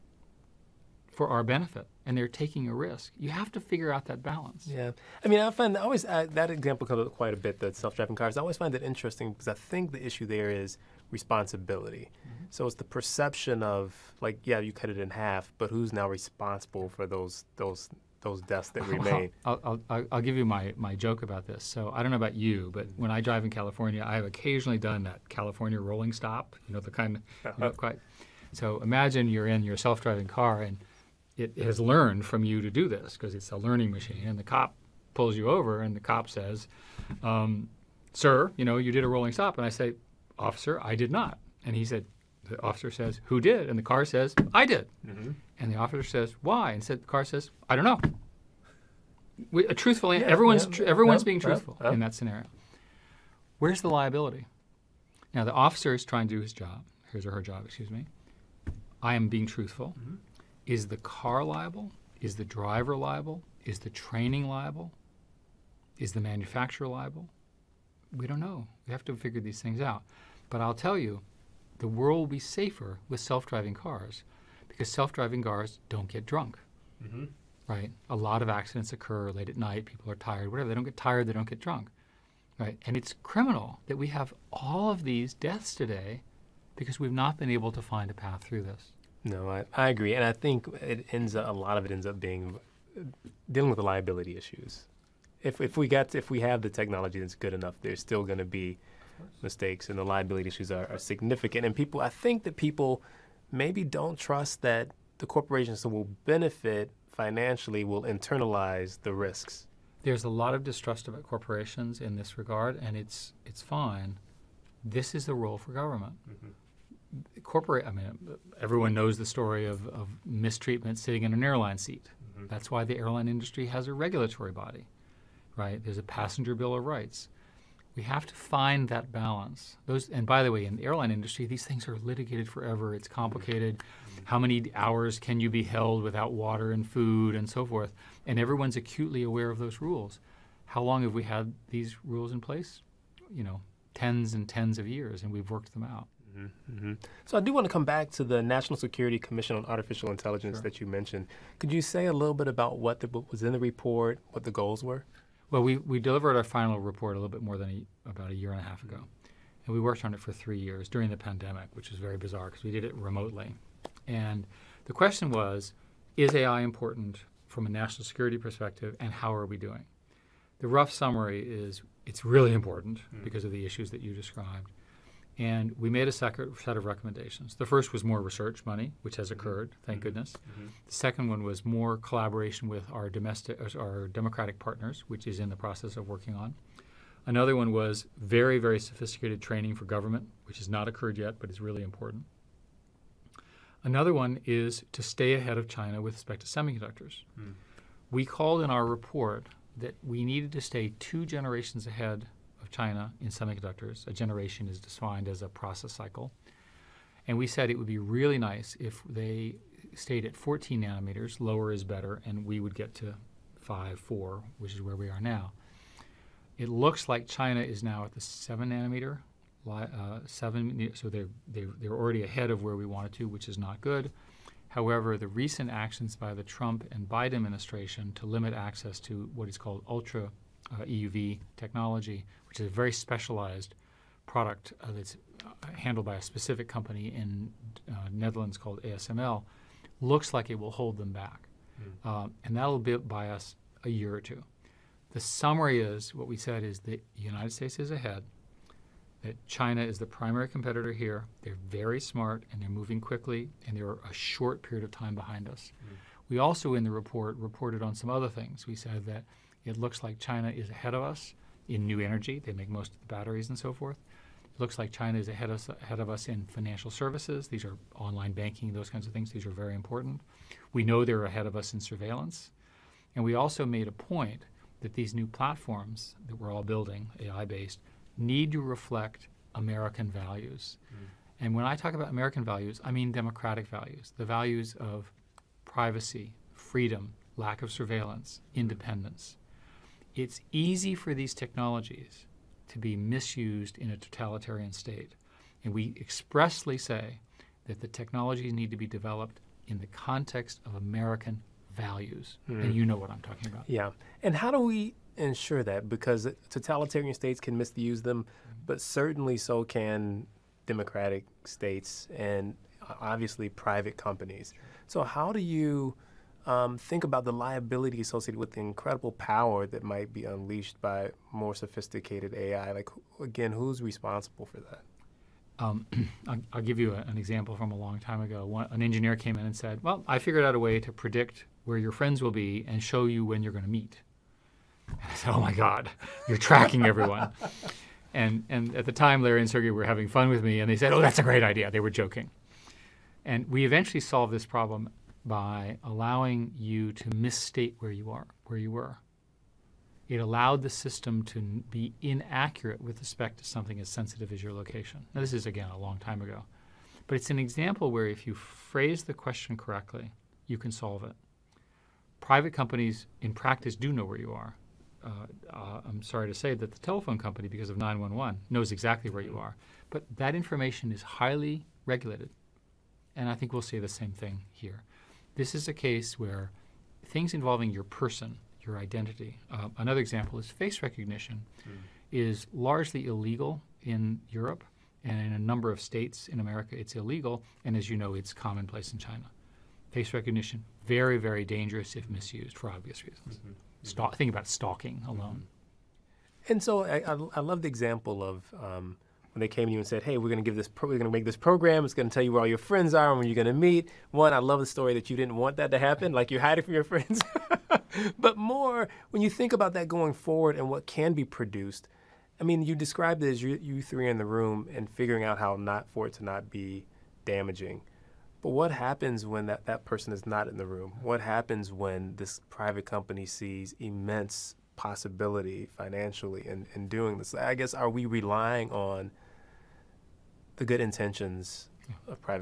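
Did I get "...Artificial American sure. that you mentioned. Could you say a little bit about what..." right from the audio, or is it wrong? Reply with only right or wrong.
wrong.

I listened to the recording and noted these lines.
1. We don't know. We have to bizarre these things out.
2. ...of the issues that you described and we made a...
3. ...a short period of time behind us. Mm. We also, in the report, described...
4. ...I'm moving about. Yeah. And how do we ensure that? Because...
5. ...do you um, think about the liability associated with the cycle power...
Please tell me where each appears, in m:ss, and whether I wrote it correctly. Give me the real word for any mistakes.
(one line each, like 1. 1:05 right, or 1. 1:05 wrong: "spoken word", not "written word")
1. 1:08 wrong: "figure", not "bizarre"
2. 2:53 right
3. 4:13 wrong: "reported", not "described"
4. 5:03 wrong: "talking", not "moving"
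5. 5:15 wrong: "incredible", not "cycle".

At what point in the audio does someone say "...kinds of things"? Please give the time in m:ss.
4:28.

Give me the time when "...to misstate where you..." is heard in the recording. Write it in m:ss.
5:46.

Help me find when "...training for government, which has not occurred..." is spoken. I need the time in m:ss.
3:09.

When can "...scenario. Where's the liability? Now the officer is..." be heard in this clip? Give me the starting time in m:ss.
0:52.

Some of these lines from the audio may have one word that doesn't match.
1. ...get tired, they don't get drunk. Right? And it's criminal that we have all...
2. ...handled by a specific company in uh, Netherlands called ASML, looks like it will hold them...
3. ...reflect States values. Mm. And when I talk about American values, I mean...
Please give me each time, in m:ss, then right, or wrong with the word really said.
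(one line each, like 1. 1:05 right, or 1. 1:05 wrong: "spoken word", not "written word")
1. 1:20 right
2. 3:55 right
3. 4:38 wrong: "American", not "States".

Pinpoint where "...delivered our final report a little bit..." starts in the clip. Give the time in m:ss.
2:35.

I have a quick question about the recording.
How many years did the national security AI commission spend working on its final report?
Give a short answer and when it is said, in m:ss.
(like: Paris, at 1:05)
3, at 2:40.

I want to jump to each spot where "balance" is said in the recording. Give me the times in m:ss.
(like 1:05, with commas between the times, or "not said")
0:04, 2:09.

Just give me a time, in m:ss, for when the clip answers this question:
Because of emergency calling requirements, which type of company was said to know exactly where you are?
6:06.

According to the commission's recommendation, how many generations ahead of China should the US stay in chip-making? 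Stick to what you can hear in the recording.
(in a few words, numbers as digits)
2.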